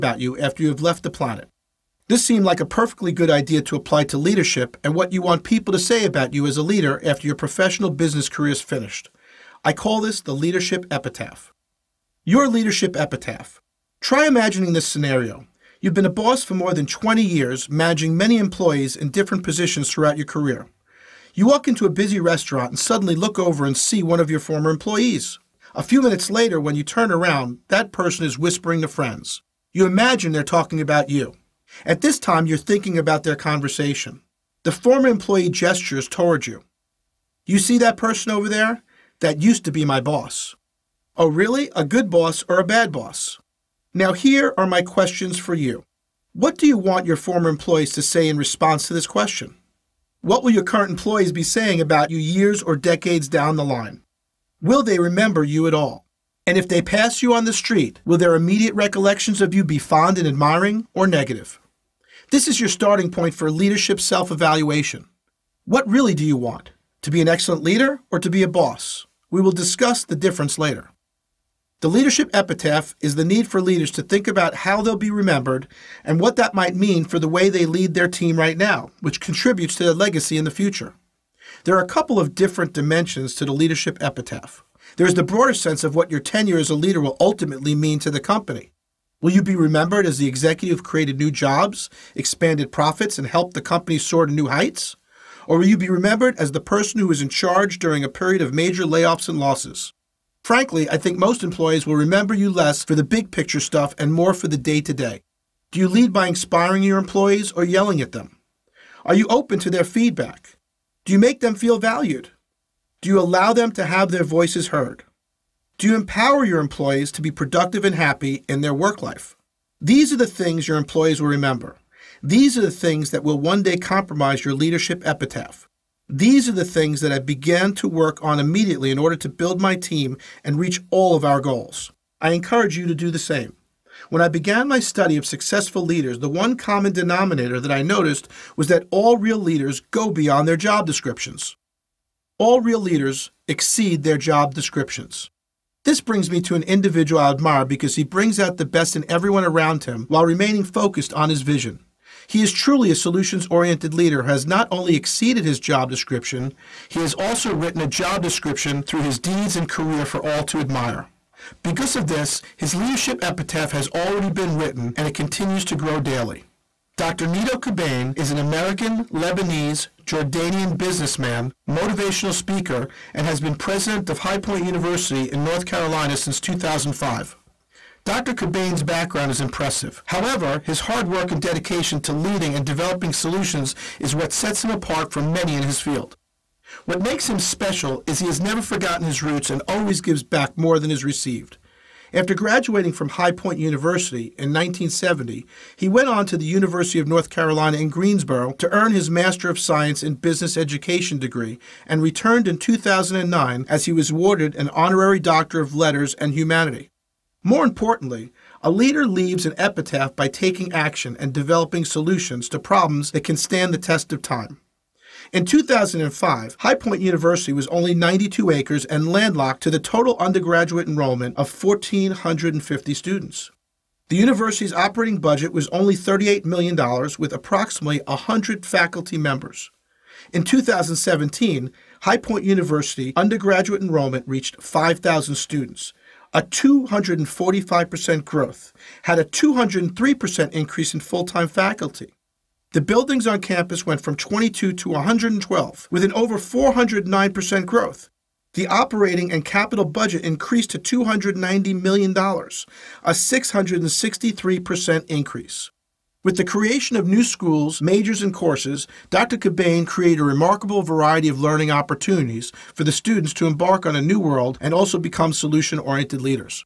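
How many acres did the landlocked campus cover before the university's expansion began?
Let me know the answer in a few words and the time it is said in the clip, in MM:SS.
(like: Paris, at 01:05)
92, at 03:37.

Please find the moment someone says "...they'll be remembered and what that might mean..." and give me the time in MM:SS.
01:14.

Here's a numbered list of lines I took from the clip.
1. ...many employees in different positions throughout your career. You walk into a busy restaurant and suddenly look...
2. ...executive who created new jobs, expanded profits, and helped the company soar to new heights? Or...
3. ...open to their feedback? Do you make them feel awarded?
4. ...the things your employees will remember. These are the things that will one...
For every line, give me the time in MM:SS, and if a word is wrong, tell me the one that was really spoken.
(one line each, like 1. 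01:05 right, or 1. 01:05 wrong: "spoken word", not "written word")
1. 00:18 right
2. 01:30 right
3. 01:49 wrong: "valued", not "awarded"
4. 02:00 right.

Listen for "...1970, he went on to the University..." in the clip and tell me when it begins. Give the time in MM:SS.
03:14.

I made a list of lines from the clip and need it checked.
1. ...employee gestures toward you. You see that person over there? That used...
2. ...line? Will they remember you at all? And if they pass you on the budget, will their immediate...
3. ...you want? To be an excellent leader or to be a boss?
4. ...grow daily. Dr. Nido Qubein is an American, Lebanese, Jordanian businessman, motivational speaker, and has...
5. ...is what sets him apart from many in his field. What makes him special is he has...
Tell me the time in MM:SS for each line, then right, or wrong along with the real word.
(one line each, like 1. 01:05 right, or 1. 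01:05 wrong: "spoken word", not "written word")
1. 00:35 right
2. 00:53 wrong: "street", not "budget"
3. 01:06 right
4. 02:45 right
5. 03:03 right.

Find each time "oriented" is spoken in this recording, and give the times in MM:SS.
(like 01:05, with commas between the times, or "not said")
02:33, 04:25.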